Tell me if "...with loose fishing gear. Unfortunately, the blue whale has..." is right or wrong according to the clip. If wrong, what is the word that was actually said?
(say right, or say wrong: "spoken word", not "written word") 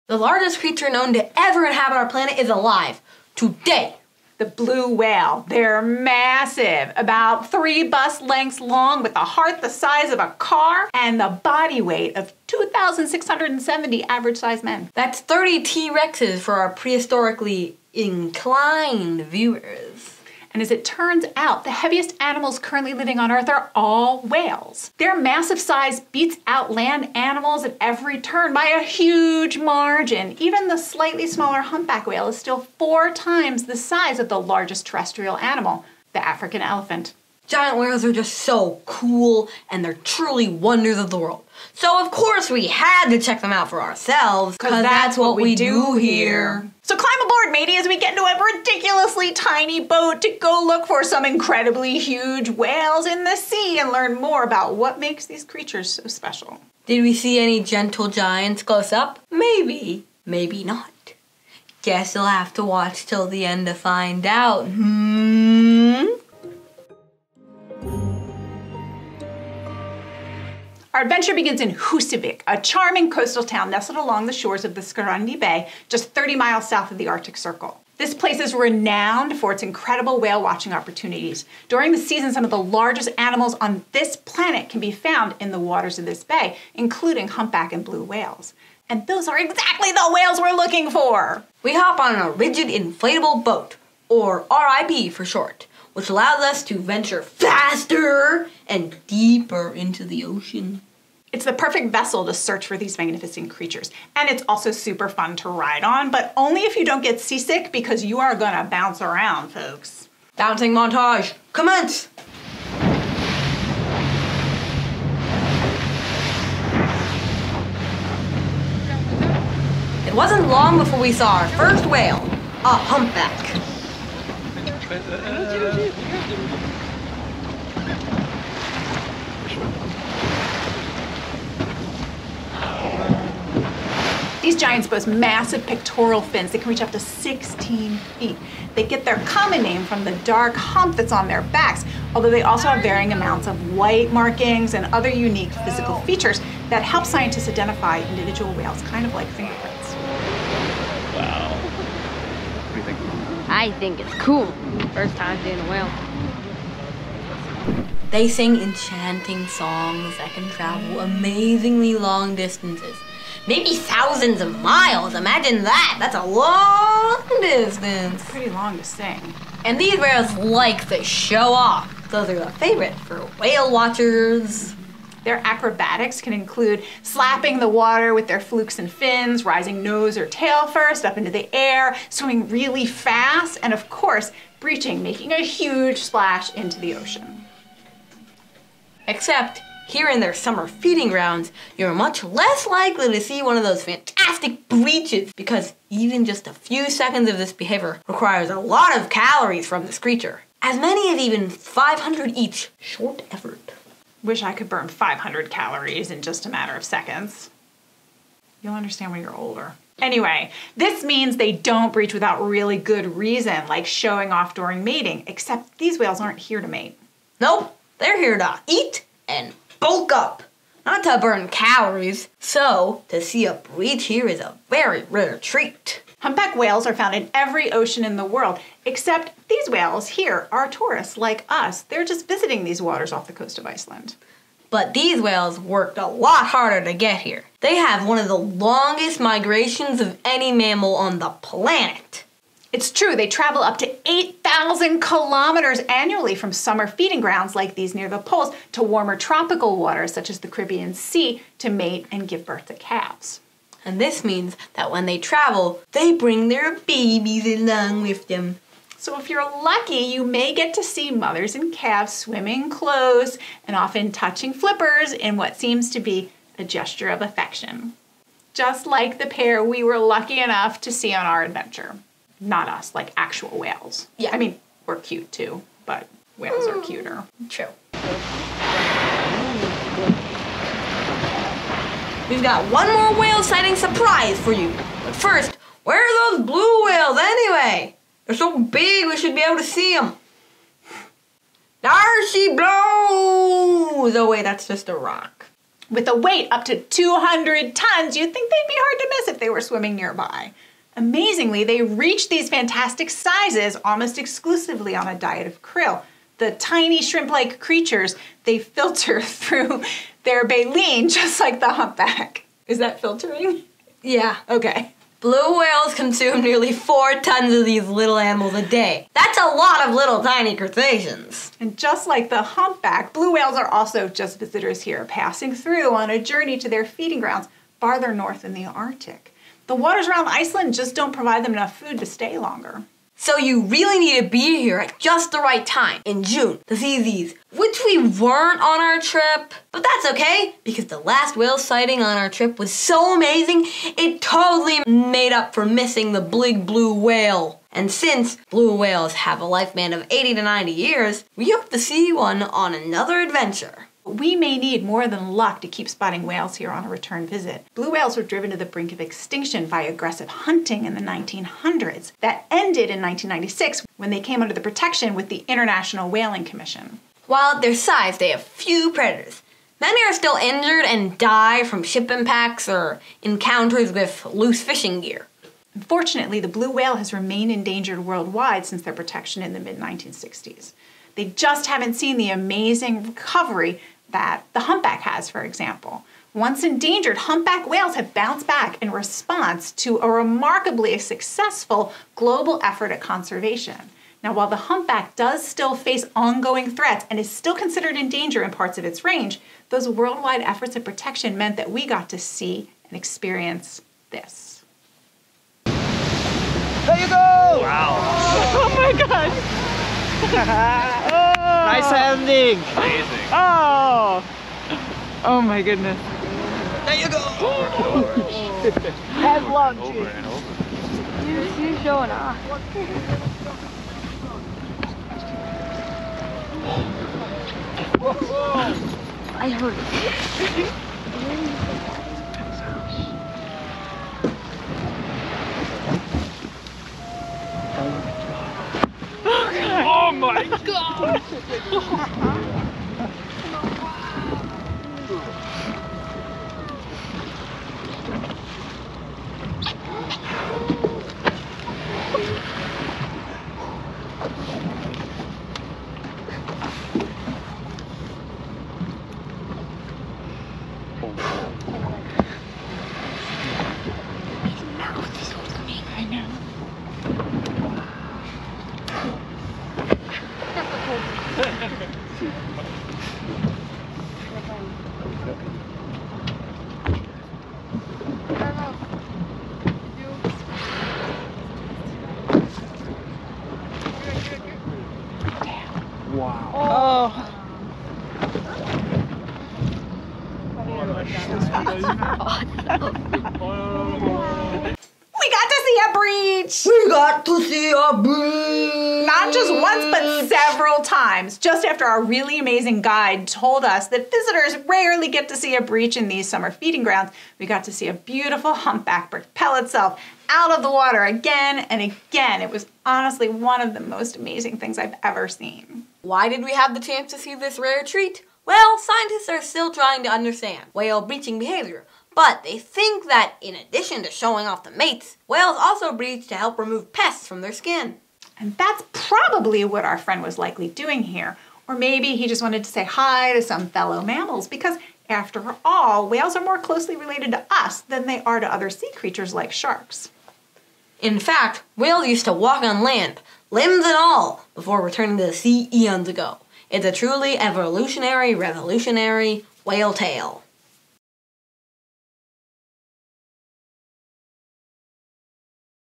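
right.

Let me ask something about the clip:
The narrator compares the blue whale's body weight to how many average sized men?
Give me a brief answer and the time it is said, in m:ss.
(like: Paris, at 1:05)
2,670, at 0:12.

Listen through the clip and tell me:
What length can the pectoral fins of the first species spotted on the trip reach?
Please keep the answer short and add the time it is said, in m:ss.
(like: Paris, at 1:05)
16 feet, at 2:16.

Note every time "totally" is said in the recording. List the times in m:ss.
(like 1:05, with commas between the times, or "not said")
5:44.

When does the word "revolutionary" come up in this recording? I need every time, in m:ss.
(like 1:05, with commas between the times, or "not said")
9:08.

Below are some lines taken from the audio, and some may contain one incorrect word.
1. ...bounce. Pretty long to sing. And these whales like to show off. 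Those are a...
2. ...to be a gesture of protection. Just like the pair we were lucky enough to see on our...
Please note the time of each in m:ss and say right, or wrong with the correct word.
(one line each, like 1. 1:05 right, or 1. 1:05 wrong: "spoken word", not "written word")
1. 2:47 wrong: "distance", not "bounce"
2. 4:25 wrong: "affection", not "protection".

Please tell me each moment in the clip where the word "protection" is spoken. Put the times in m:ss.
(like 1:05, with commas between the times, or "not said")
6:04, 6:18, 6:40.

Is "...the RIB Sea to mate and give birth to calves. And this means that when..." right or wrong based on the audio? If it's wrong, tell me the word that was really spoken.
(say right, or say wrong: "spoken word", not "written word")
wrong: "Caribbean", not "RIB".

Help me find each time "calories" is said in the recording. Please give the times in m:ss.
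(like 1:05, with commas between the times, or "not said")
3:19, 3:25, 3:41.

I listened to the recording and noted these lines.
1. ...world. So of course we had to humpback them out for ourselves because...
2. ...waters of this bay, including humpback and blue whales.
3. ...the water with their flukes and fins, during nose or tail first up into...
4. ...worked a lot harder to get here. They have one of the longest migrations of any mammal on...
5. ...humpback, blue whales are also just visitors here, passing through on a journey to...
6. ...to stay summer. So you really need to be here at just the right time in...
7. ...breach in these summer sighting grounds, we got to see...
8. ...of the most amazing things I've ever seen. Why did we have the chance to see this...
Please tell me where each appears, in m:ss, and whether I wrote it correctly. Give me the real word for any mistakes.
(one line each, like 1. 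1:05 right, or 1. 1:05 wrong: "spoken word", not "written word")
1. 0:41 wrong: "check", not "humpback"
2. 1:25 right
3. 2:57 wrong: "rising", not "during"
4. 3:55 right
5. 5:22 right
6. 5:31 wrong: "longer", not "summer"
7. 8:25 wrong: "feeding", not "sighting"
8. 8:33 right.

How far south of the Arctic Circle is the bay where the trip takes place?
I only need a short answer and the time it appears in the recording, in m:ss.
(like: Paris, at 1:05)
30 miles, at 1:16.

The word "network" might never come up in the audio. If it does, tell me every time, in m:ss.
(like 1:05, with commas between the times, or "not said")
not said.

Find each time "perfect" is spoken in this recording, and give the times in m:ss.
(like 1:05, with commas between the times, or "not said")
1:41.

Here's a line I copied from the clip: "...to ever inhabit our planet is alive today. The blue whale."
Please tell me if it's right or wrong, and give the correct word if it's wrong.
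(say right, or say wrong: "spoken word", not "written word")
right.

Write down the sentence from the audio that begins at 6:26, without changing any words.
Once endangered, humpback whales have bounced back in response to a remarkably successful global effort at conservation.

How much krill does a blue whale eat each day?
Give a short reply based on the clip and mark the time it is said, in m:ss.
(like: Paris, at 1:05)
nearly four tons, at 5:16.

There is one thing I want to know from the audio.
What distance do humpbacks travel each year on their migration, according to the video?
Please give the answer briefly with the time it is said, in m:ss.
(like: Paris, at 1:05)
8,000 kilometers, at 4:04.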